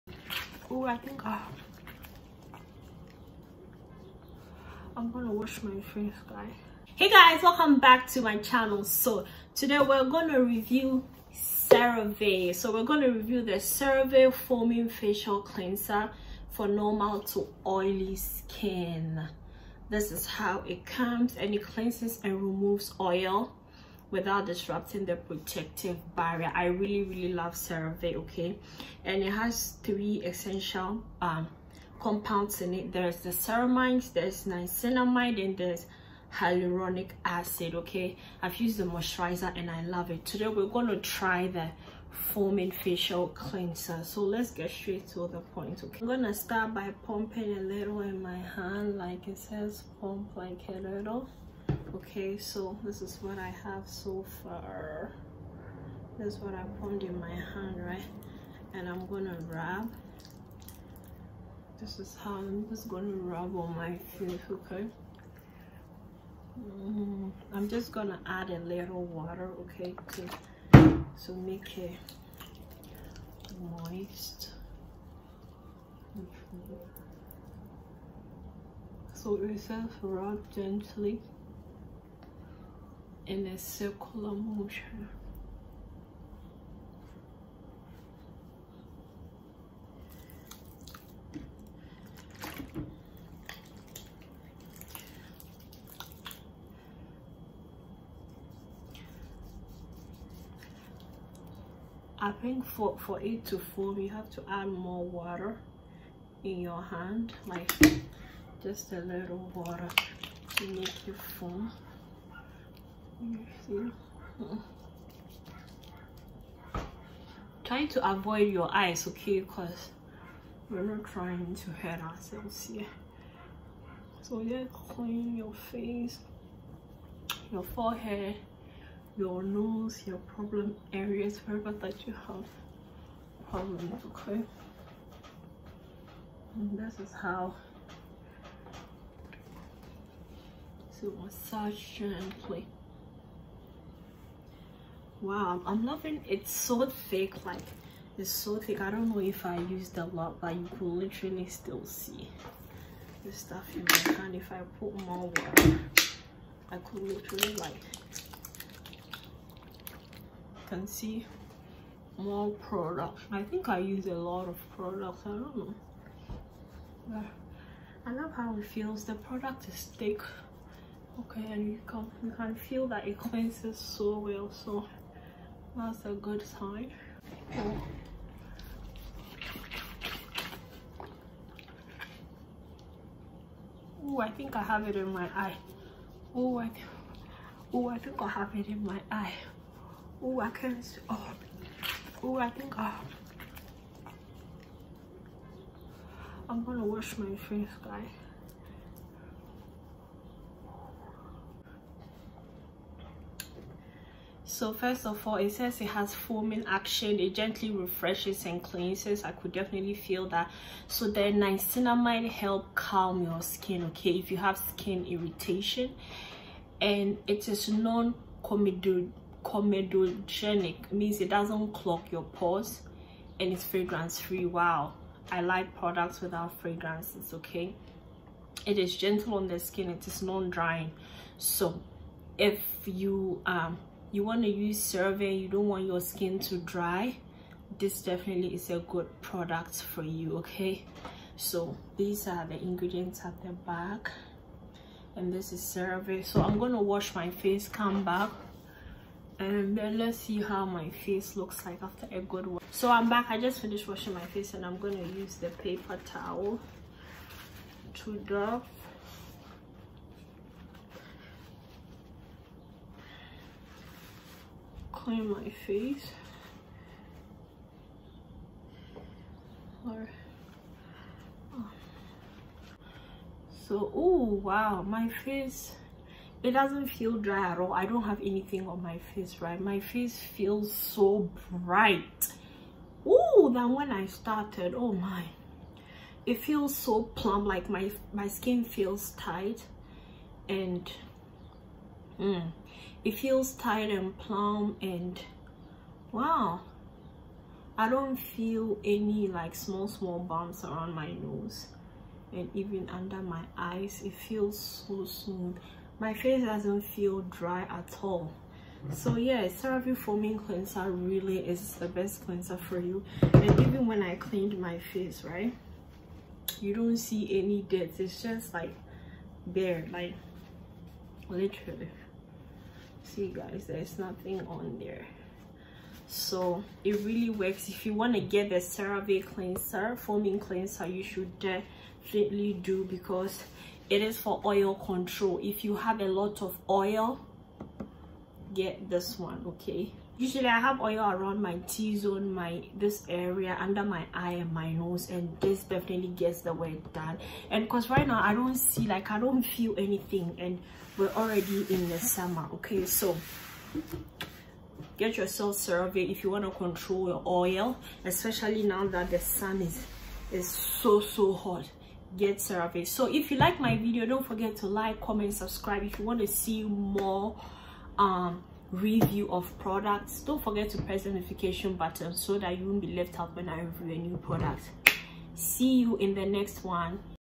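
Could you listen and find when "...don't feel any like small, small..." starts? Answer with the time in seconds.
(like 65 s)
297 s.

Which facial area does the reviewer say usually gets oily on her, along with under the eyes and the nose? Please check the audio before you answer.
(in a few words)
T-zone.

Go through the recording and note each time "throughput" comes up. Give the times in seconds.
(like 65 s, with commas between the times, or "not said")
not said.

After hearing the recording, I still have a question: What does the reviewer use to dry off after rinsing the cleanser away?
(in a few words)
paper towel.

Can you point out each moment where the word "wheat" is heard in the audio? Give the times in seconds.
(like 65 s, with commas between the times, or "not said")
not said.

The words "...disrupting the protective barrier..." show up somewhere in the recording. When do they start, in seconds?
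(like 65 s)
24 s.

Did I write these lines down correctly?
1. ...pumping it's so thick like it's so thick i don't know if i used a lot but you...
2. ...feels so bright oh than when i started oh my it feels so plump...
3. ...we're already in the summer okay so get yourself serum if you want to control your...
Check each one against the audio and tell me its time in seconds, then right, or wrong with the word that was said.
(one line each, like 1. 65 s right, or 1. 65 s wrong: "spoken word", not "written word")
1. 145 s wrong: "loving", not "pumping"
2. 280 s right
3. 350 s right.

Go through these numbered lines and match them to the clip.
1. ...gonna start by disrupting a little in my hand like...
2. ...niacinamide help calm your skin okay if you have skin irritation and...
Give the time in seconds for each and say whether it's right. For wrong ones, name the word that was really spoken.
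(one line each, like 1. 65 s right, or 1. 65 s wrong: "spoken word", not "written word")
1. 46 s wrong: "pumping", not "disrupting"
2. 211 s right.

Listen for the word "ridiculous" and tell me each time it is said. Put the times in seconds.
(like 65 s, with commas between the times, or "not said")
not said.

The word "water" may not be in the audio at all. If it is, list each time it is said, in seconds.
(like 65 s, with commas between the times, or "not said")
69 s, 105 s, 109 s, 155 s.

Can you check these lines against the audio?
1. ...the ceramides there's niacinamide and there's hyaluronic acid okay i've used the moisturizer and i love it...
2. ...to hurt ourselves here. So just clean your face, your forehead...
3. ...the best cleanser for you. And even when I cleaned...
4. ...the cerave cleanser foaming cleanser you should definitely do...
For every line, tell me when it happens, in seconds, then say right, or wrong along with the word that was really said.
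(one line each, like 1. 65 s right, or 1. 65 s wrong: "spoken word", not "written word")
1. 33 s right
2. 121 s right
3. 311 s right
4. 328 s right.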